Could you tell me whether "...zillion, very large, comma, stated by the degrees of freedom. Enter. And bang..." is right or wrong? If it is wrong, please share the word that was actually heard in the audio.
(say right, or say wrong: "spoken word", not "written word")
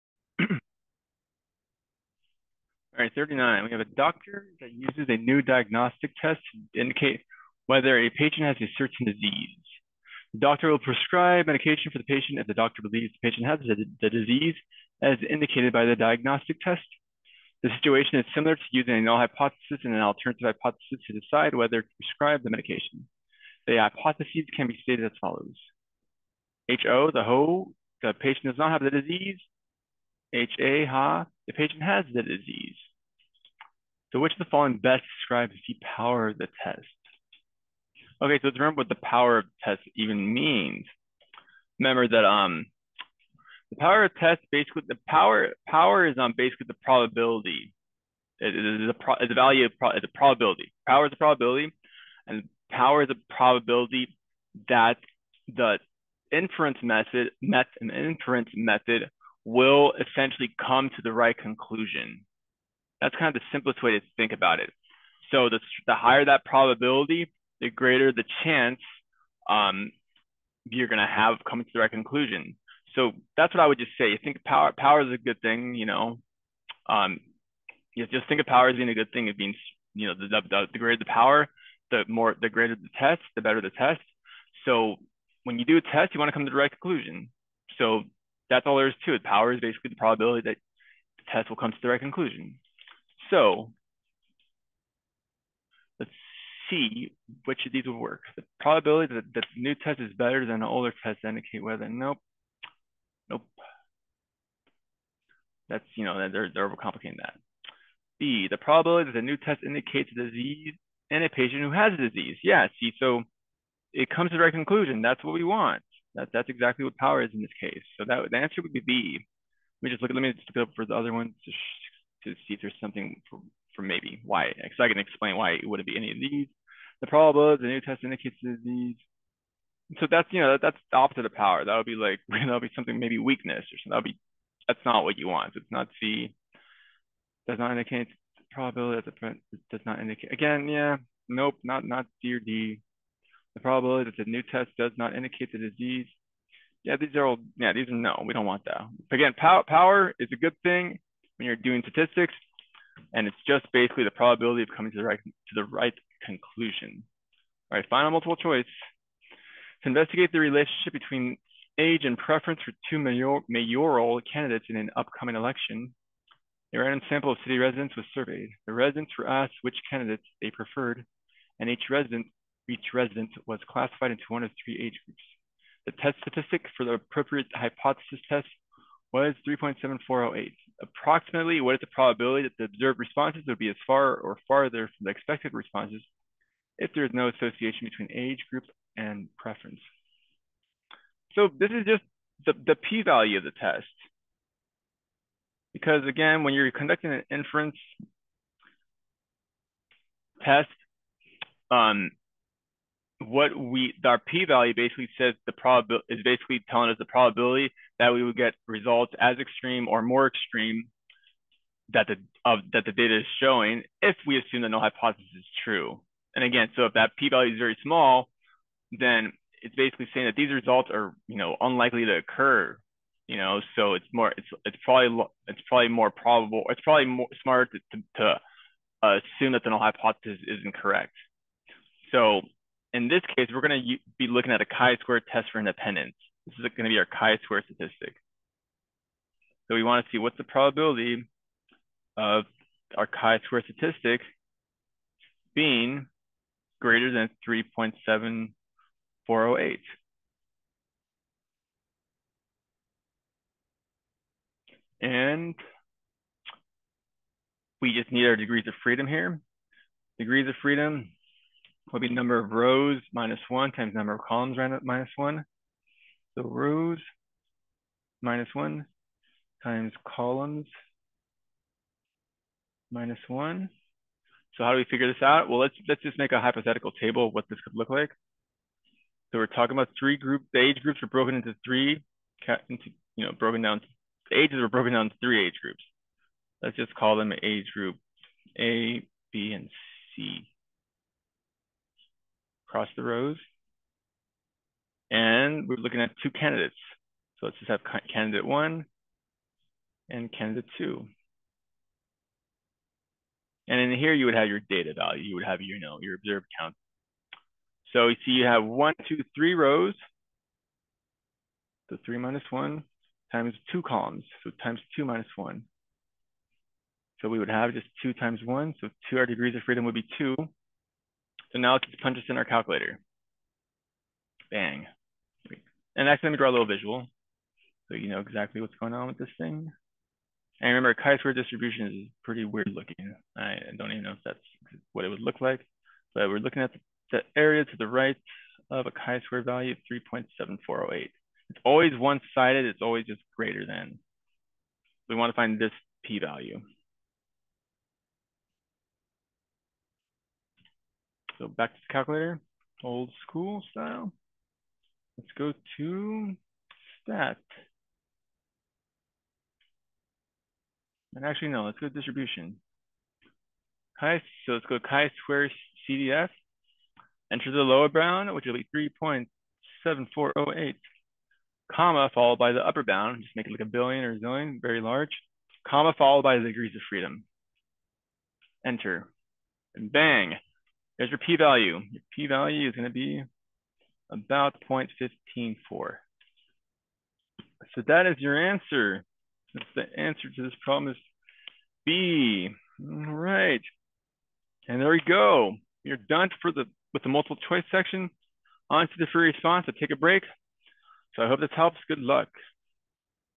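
wrong: "followed", not "stated".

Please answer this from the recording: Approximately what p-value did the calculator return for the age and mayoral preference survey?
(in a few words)
0.154.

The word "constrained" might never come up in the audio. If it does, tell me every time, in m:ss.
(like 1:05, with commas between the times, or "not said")
not said.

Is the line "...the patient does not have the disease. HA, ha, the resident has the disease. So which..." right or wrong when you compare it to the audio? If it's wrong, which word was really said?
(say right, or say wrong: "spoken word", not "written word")
wrong: "patient", not "resident".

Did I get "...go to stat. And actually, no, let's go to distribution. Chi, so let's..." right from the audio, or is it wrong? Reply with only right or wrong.
right.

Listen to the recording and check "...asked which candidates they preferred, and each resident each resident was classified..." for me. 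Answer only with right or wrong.
right.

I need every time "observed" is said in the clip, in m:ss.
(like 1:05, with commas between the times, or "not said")
3:02, 5:06.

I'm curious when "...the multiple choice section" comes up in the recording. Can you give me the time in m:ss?
6:37.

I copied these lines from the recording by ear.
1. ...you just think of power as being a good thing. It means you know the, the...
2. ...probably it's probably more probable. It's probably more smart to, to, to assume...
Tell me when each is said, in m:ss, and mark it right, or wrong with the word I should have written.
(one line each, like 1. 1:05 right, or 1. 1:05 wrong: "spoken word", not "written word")
1. 1:17 right
2. 3:44 right.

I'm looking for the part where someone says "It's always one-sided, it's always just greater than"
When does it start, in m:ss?
5:41.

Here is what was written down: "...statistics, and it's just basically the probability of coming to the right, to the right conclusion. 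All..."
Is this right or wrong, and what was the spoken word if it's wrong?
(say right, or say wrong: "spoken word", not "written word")
right.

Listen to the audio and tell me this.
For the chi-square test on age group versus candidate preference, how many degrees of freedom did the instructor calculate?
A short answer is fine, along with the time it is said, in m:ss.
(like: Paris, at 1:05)
2, at 5:19.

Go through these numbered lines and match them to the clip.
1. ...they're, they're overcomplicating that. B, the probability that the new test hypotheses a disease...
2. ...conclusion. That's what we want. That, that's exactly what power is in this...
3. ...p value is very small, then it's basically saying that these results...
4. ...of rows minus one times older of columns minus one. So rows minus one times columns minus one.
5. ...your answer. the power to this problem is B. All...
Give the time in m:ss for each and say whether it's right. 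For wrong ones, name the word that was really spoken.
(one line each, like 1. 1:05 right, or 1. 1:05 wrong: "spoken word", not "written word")
1. 1:46 wrong: "indicates", not "hypotheses"
2. 1:54 right
3. 3:37 right
4. 4:22 wrong: "number", not "older"
5. 6:28 wrong: "answer", not "power".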